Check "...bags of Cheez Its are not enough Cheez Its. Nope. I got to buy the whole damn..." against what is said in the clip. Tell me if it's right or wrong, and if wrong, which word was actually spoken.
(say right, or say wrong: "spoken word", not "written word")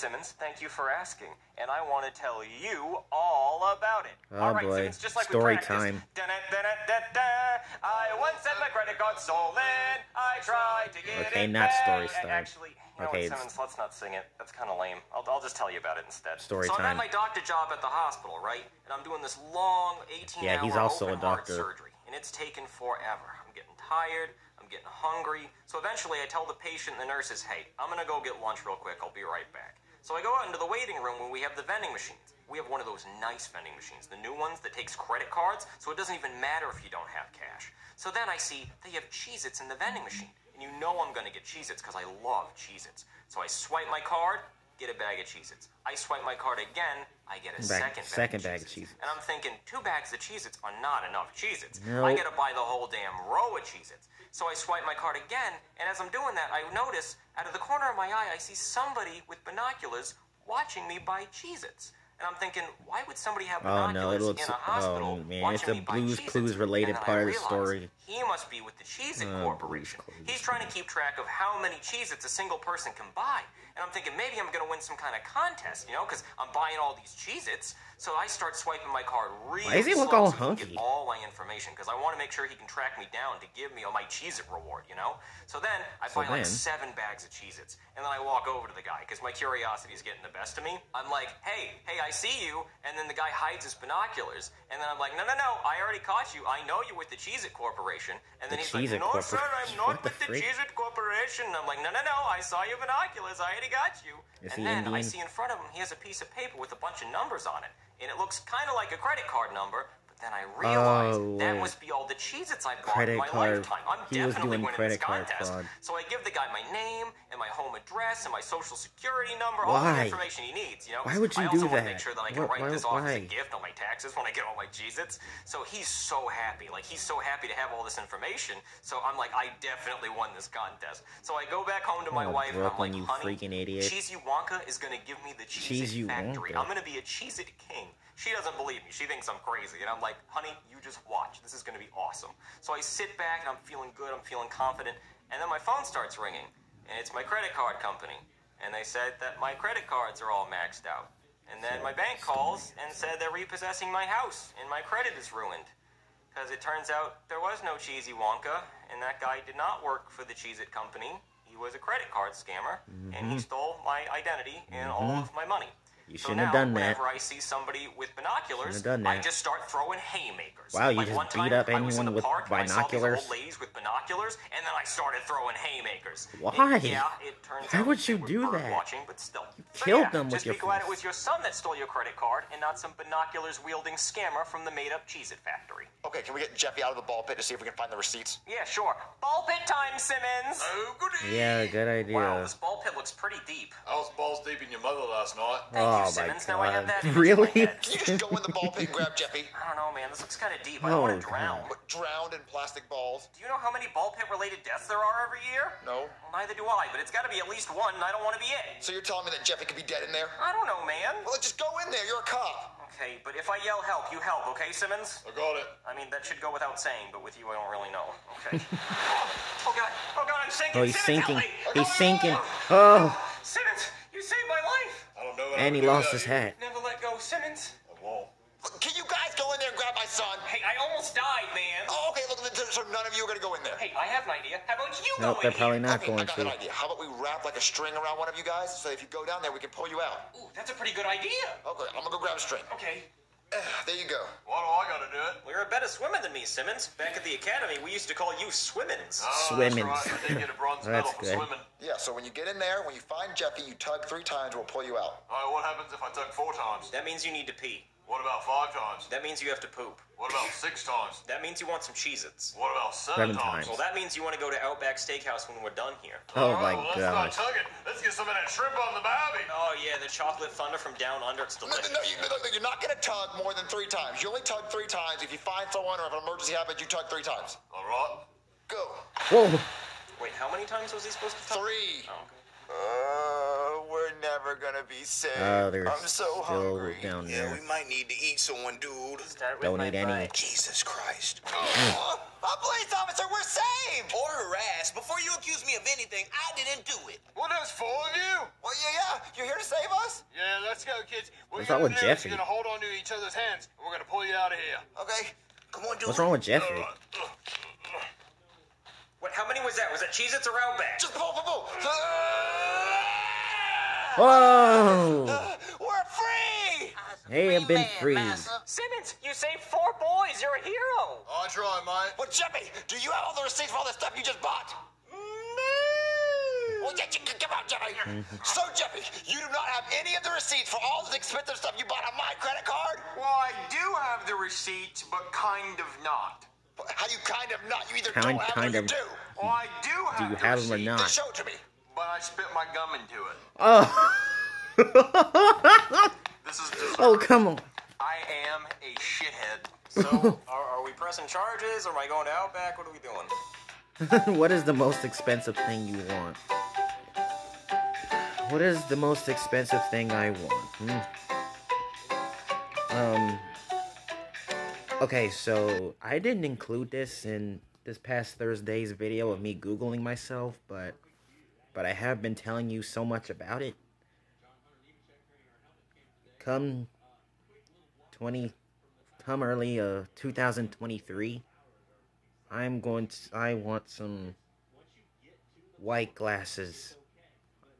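right.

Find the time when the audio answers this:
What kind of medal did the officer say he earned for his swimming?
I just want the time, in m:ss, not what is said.
4:10.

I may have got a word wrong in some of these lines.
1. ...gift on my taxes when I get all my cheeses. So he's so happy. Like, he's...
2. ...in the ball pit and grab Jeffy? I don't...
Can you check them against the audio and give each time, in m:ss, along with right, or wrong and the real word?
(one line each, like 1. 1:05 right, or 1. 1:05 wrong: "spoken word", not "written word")
1. 2:03 right
2. 3:18 right.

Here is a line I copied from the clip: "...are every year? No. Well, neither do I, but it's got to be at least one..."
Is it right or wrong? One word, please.
right.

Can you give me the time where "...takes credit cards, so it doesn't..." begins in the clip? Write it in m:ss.
0:34.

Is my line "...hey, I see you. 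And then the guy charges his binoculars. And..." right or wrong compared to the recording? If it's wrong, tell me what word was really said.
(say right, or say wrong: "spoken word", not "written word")
wrong: "hides", not "charges".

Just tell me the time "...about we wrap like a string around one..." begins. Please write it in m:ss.
3:56.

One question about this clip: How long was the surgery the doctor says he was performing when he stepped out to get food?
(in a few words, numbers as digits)
18 hours.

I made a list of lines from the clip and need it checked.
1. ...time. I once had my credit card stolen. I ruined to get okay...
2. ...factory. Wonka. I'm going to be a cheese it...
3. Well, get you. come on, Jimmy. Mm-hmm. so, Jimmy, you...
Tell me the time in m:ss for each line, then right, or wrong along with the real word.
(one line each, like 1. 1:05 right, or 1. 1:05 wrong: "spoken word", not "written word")
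1. 0:05 wrong: "tried", not "ruined"
2. 2:16 right
3. 5:26 right.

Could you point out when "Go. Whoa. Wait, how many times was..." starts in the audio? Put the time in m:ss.
4:38.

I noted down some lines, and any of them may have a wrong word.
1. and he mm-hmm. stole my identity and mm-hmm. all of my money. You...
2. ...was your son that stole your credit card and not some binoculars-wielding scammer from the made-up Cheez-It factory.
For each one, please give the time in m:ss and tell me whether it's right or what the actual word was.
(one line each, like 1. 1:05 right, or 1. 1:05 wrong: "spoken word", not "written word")
1. 2:43 right
2. 3:00 right.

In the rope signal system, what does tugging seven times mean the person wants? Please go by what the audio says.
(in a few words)
Outback Steakhouse.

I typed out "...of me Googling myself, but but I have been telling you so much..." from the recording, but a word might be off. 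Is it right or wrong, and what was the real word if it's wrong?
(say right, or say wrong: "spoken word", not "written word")
right.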